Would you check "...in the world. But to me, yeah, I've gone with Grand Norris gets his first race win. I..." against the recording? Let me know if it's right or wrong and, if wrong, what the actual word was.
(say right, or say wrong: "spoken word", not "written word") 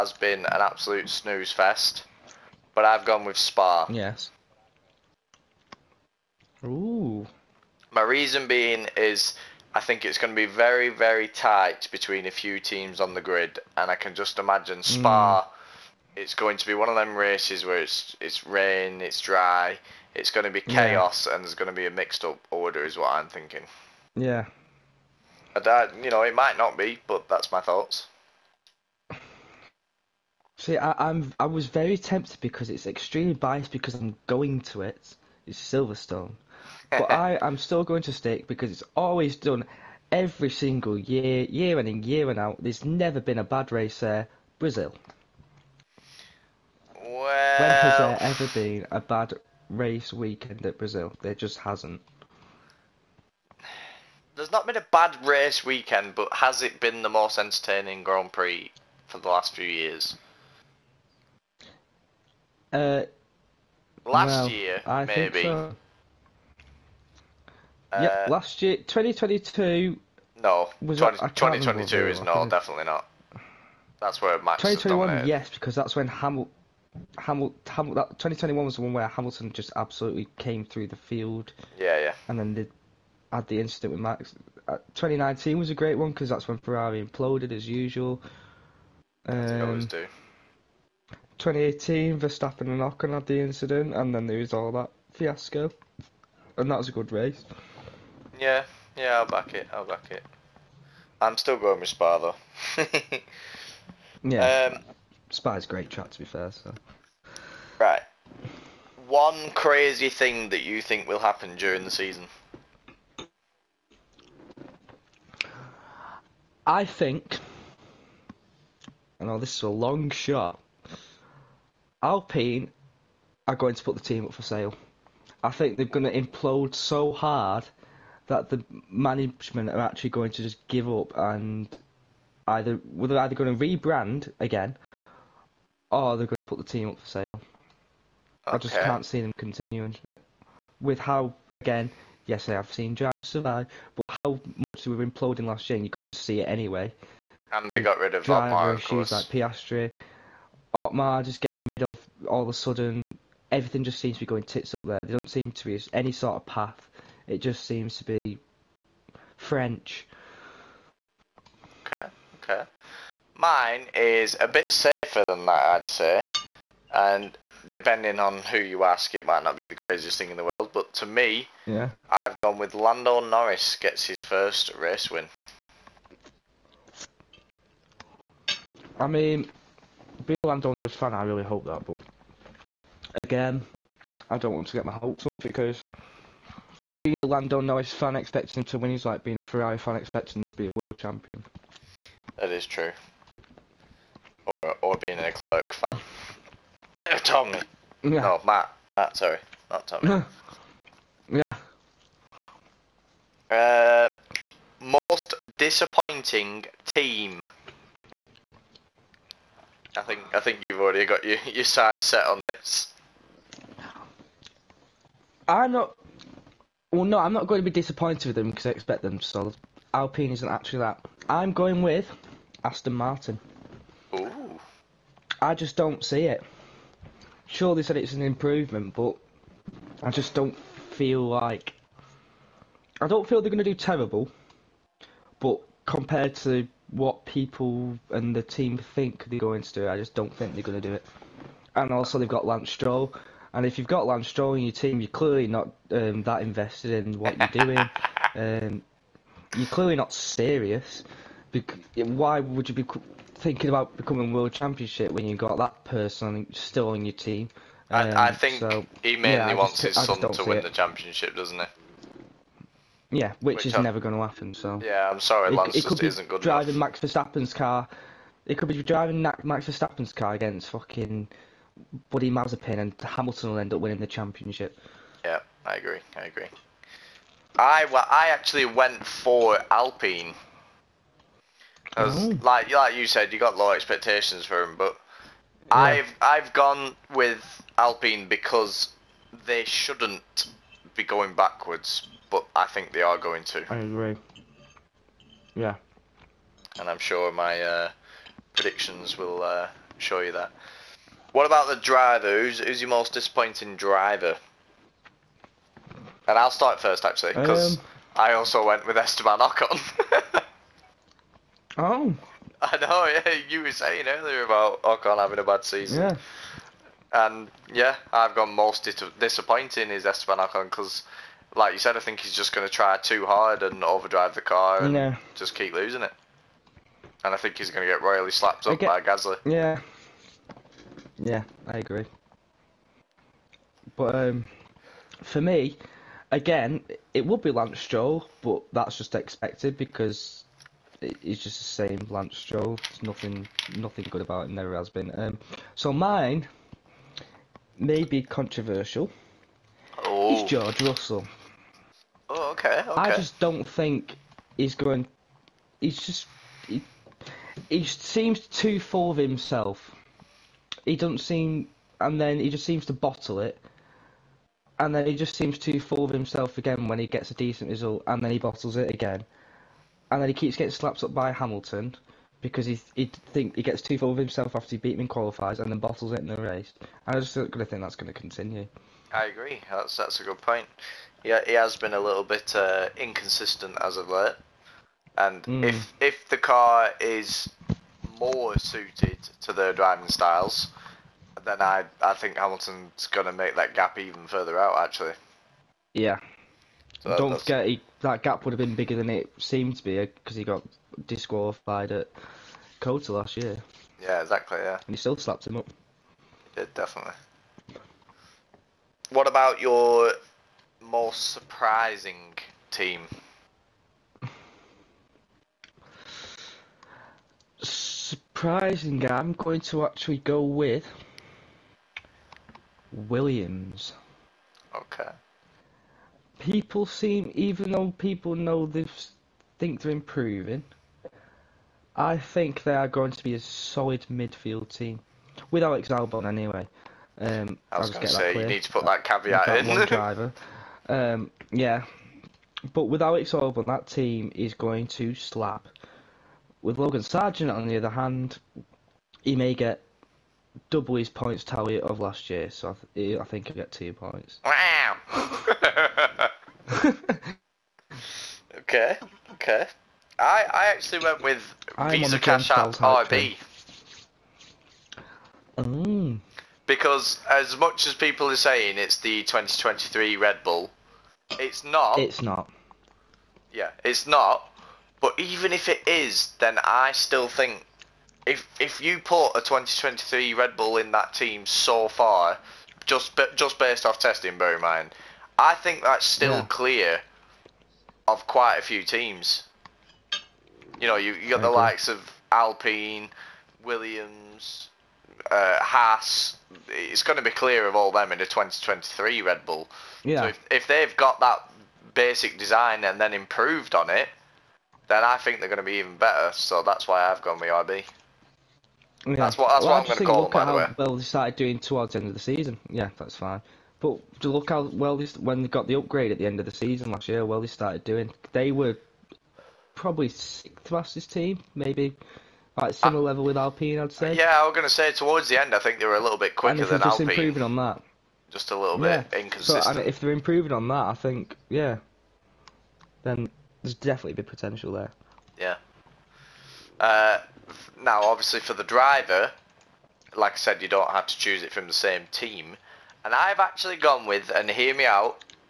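wrong: "Lando", not "Grand".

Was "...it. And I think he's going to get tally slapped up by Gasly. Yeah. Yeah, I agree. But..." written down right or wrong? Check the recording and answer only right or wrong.
wrong.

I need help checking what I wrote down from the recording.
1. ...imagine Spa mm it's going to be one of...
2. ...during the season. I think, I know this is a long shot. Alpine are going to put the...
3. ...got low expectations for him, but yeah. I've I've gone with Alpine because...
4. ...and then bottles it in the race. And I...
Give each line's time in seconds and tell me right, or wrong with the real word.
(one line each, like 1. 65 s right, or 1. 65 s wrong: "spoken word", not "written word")
1. 14 s right
2. 111 s right
3. 283 s right
4. 375 s right.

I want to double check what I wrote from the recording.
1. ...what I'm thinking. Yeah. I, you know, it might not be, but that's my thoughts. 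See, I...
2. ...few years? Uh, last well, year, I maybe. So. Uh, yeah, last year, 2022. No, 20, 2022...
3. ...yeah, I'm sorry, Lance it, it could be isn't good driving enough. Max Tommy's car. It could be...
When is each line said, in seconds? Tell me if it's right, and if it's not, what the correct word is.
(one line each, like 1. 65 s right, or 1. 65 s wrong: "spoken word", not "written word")
1. 22 s right
2. 59 s right
3. 264 s wrong: "Verstappen", not "Tommy".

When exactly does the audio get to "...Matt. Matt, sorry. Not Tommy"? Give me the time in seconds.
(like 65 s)
198 s.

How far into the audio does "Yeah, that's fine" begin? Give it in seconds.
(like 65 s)
512 s.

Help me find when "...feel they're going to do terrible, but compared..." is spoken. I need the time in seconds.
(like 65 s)
233 s.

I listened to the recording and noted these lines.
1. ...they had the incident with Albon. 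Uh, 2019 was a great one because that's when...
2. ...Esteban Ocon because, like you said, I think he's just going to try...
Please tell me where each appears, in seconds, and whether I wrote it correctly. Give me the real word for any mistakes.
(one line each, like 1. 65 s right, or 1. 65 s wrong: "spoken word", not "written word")
1. 82 s wrong: "Max", not "Albon"
2. 320 s right.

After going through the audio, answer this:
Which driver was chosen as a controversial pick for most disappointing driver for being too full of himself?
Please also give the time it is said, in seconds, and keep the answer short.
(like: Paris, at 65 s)
George Russell, at 350 s.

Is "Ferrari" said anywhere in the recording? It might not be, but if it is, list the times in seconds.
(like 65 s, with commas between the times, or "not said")
86 s, 189 s.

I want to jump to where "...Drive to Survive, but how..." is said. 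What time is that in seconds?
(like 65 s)
142 s.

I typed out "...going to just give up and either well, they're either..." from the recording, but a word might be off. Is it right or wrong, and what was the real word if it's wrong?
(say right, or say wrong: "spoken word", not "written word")
right.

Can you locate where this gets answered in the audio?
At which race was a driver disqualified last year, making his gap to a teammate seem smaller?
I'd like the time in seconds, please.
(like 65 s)
402 s.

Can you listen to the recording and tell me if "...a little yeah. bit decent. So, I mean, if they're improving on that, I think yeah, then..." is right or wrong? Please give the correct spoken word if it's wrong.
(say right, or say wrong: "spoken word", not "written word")
wrong: "inconsistent", not "decent".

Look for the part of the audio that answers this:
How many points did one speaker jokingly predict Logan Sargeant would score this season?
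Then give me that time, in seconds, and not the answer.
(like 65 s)
453 s.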